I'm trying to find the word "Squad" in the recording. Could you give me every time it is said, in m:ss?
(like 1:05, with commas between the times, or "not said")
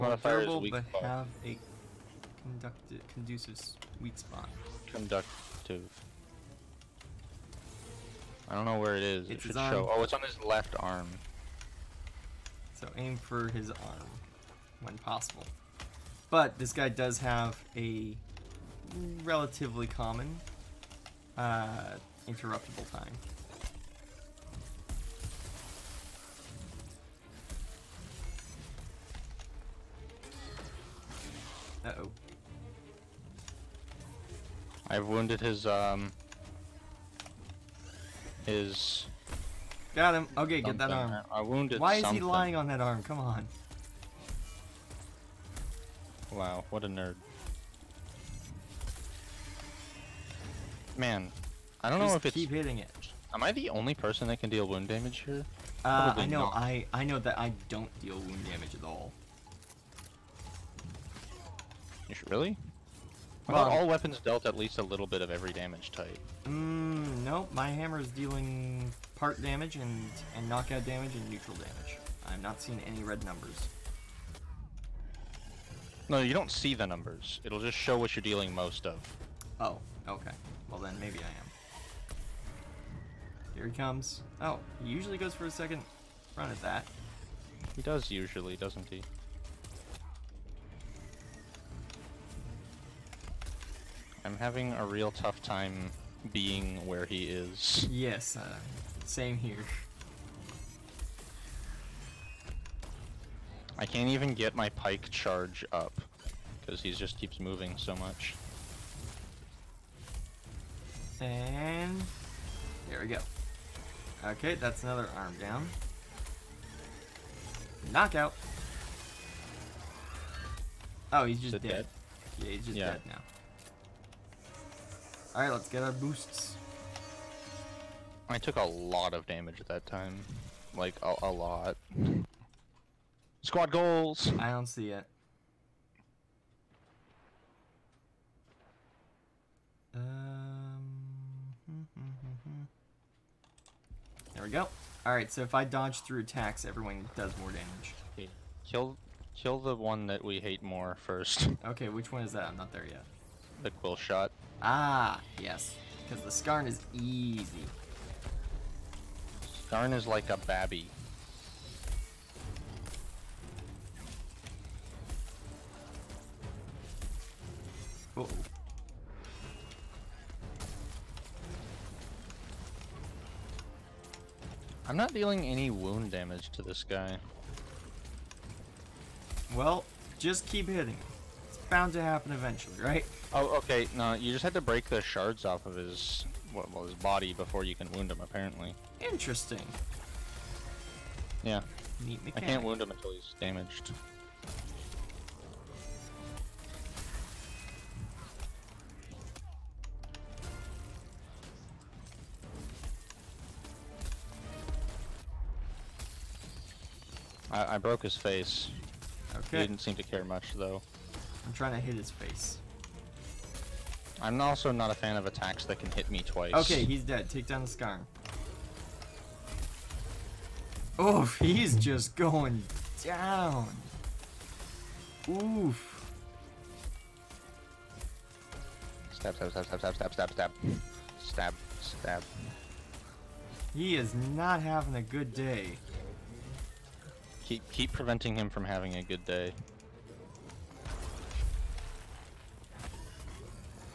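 2:13.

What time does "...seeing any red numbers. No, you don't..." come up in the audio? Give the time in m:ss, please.
1:12.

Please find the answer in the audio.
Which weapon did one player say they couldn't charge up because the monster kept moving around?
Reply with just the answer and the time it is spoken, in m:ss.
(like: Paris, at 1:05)
Pike, at 1:44.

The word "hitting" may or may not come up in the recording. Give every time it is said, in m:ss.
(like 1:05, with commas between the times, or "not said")
0:52, 3:00.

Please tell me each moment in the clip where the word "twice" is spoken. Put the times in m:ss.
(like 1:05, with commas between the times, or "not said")
3:36.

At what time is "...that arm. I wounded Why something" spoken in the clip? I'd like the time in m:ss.
0:40.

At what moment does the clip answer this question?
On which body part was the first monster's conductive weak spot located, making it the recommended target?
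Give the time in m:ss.
0:10.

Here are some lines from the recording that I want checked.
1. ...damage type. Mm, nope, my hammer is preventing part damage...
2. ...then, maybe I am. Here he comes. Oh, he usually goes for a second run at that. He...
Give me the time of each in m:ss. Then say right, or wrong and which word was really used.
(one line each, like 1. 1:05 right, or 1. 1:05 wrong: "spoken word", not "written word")
1. 1:05 wrong: "dealing", not "preventing"
2. 1:20 right.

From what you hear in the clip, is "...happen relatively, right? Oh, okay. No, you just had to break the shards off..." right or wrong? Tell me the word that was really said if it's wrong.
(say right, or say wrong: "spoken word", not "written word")
wrong: "eventually", not "relatively".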